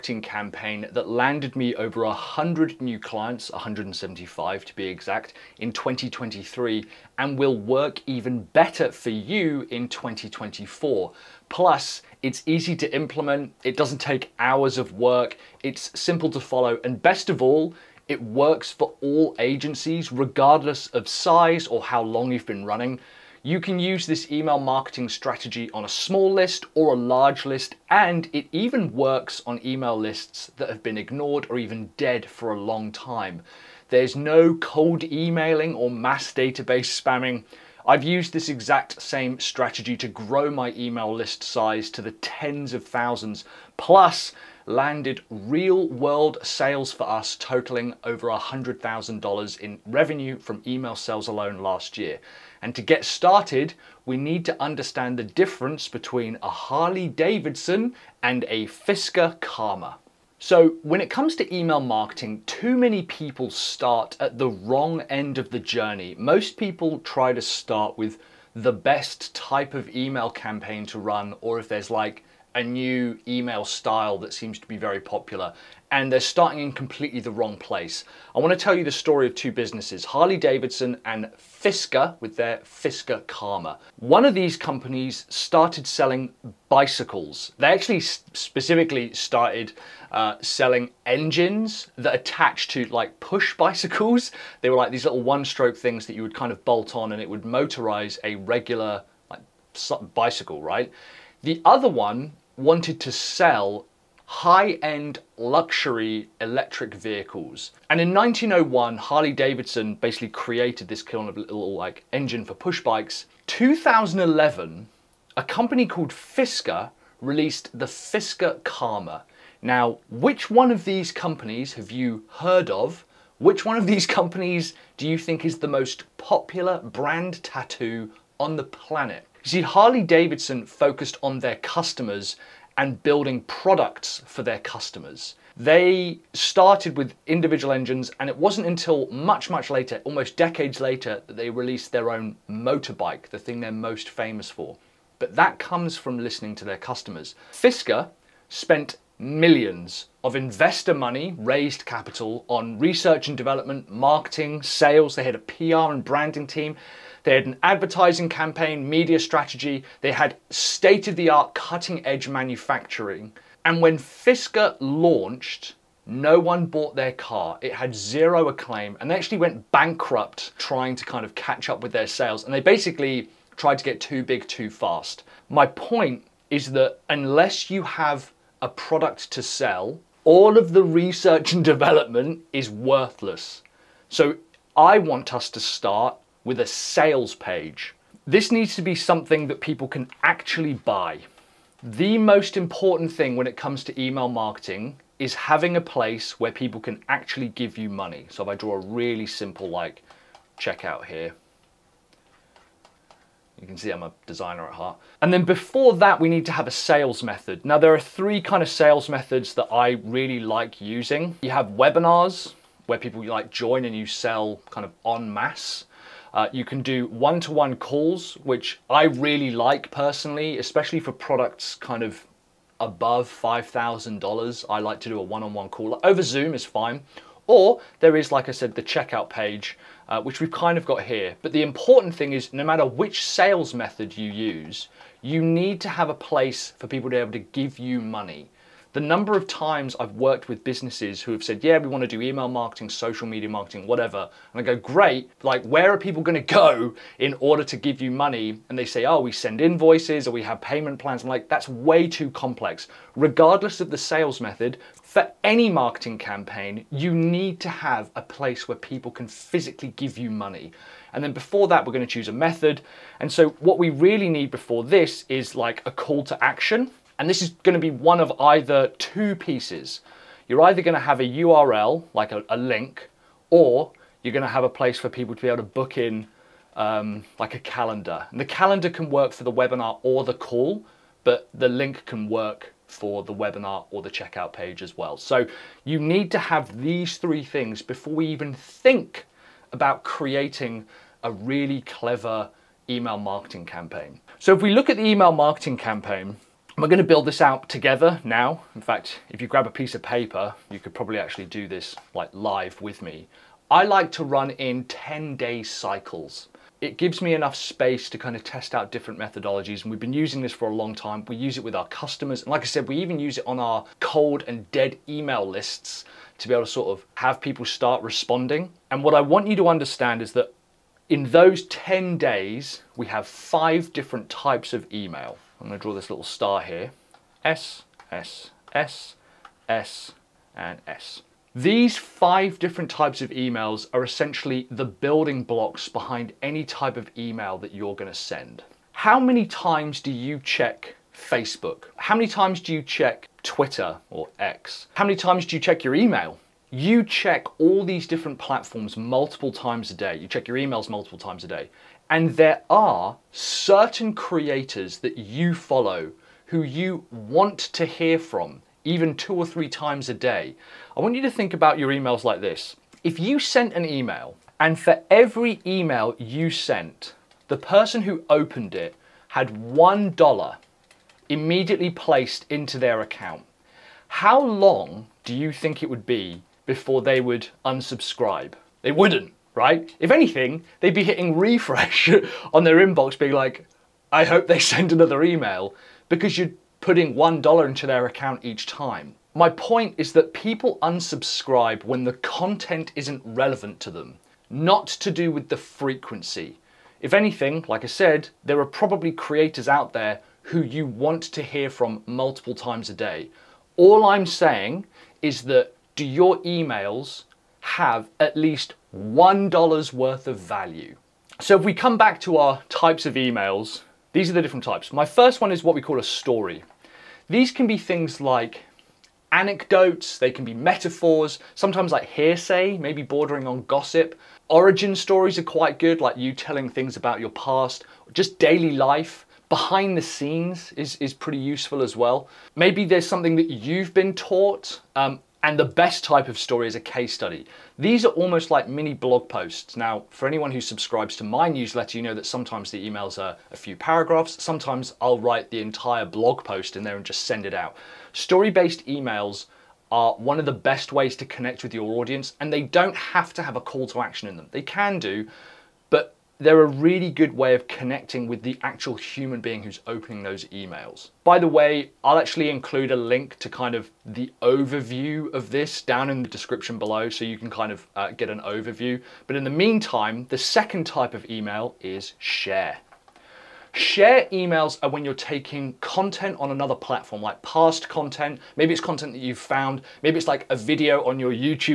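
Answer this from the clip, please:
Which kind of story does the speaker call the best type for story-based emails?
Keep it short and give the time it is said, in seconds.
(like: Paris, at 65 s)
Case study, at 436 s.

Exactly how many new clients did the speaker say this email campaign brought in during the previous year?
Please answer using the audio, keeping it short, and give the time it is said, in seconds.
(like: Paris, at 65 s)
175, at 3 s.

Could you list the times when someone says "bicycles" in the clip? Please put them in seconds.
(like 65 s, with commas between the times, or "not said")
86 s, 93 s, 100 s.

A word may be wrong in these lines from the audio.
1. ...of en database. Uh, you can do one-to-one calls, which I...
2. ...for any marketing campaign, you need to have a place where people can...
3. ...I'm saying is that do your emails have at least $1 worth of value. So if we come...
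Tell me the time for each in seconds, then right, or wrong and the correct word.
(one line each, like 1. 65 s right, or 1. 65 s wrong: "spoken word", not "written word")
1. 214 s wrong: "masse", not "database"
2. 255 s right
3. 404 s right.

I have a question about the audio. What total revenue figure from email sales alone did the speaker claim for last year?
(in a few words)
$100,000.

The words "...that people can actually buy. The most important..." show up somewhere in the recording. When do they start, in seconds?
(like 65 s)
189 s.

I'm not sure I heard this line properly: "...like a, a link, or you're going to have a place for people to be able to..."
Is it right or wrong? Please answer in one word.
right.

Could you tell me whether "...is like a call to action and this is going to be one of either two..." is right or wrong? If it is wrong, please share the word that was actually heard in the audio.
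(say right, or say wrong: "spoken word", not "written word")
right.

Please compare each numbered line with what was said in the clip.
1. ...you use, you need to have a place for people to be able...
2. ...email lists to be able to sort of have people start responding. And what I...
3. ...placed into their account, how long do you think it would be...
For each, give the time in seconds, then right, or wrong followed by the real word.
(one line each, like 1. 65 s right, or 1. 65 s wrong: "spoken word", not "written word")
1. 234 s right
2. 315 s right
3. 371 s right.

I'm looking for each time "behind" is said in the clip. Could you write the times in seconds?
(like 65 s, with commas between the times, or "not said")
335 s, 429 s.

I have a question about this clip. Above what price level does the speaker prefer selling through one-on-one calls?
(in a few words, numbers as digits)
$5,000.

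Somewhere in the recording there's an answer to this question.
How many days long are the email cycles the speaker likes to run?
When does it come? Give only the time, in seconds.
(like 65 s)
304 s.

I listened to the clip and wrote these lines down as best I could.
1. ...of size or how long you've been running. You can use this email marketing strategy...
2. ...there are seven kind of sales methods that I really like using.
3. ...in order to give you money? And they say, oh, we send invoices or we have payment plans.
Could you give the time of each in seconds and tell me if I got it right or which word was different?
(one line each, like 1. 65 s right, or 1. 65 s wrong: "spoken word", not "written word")
1. 20 s right
2. 207 s wrong: "three", not "seven"
3. 247 s right.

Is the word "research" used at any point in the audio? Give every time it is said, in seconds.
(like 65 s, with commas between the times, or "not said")
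152 s, 180 s.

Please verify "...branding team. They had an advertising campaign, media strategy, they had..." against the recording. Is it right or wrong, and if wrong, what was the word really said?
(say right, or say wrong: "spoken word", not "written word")
right.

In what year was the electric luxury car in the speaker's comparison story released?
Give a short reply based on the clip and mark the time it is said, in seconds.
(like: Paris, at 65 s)
2011, at 113 s.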